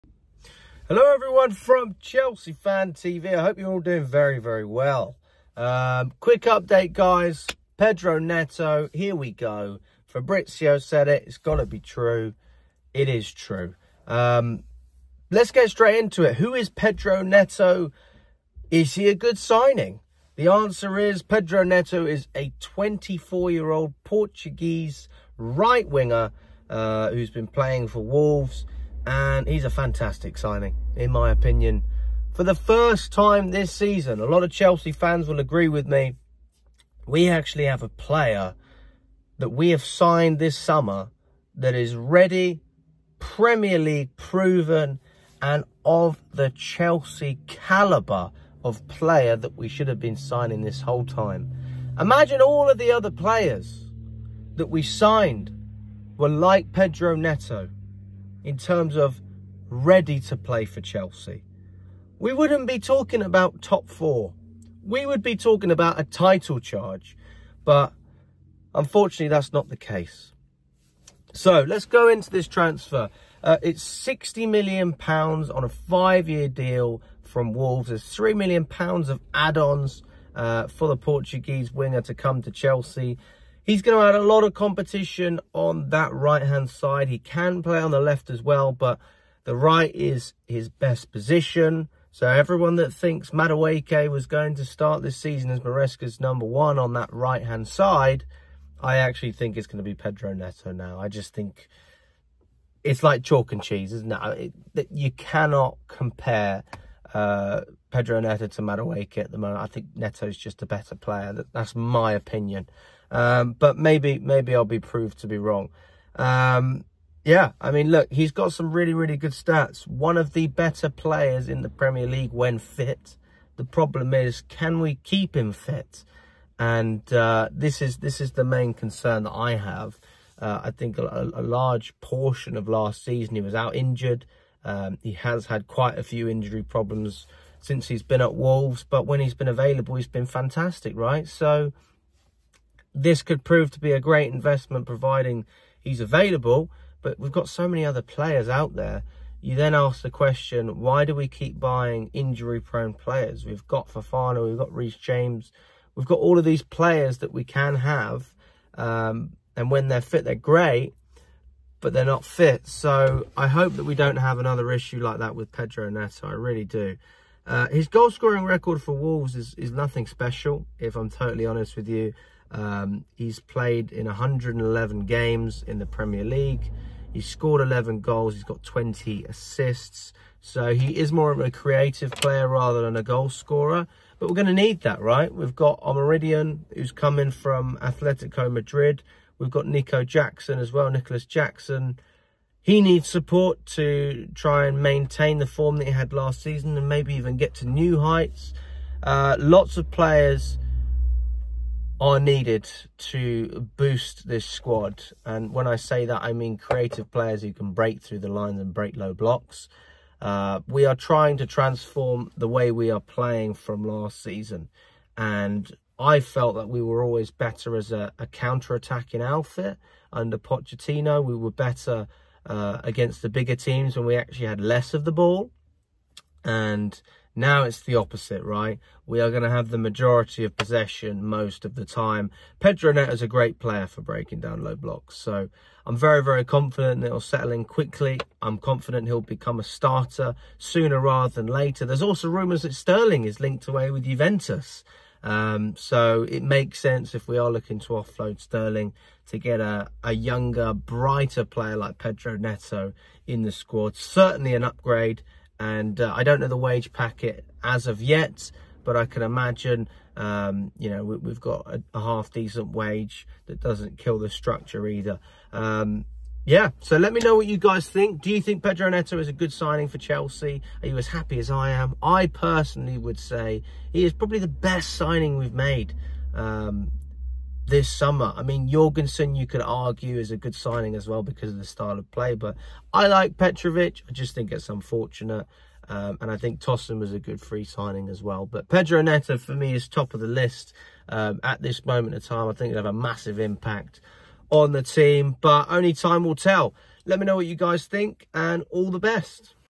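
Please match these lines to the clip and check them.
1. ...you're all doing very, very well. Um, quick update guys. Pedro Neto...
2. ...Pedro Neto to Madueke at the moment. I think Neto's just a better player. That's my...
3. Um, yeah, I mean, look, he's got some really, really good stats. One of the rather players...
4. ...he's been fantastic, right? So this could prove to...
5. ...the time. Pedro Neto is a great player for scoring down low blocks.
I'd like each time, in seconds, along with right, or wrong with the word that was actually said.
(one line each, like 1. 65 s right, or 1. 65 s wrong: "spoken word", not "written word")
1. 3 s right
2. 107 s right
3. 116 s wrong: "better", not "rather"
4. 139 s right
5. 231 s wrong: "breaking", not "scoring".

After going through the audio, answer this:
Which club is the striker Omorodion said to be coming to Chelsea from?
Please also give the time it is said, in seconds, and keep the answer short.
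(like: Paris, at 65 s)
Atletico Madrid, at 187 s.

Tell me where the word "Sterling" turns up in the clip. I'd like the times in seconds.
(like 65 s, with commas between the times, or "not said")
242 s, 248 s.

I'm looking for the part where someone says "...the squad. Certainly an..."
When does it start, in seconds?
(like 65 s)
253 s.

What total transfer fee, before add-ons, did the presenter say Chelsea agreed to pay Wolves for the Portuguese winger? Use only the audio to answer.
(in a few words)
£60 million.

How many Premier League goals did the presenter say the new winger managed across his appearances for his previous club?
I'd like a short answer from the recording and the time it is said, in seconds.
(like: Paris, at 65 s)
11, at 177 s.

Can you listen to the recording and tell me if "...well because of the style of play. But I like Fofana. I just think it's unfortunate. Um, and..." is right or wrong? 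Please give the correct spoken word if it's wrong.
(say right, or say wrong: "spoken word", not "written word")
wrong: "Petrovic", not "Fofana".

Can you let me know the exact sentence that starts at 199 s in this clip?
Uh, lots of players are needed to boost this squad.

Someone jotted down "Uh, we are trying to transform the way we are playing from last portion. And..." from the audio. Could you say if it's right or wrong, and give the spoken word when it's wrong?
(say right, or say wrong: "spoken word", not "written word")
wrong: "season", not "portion".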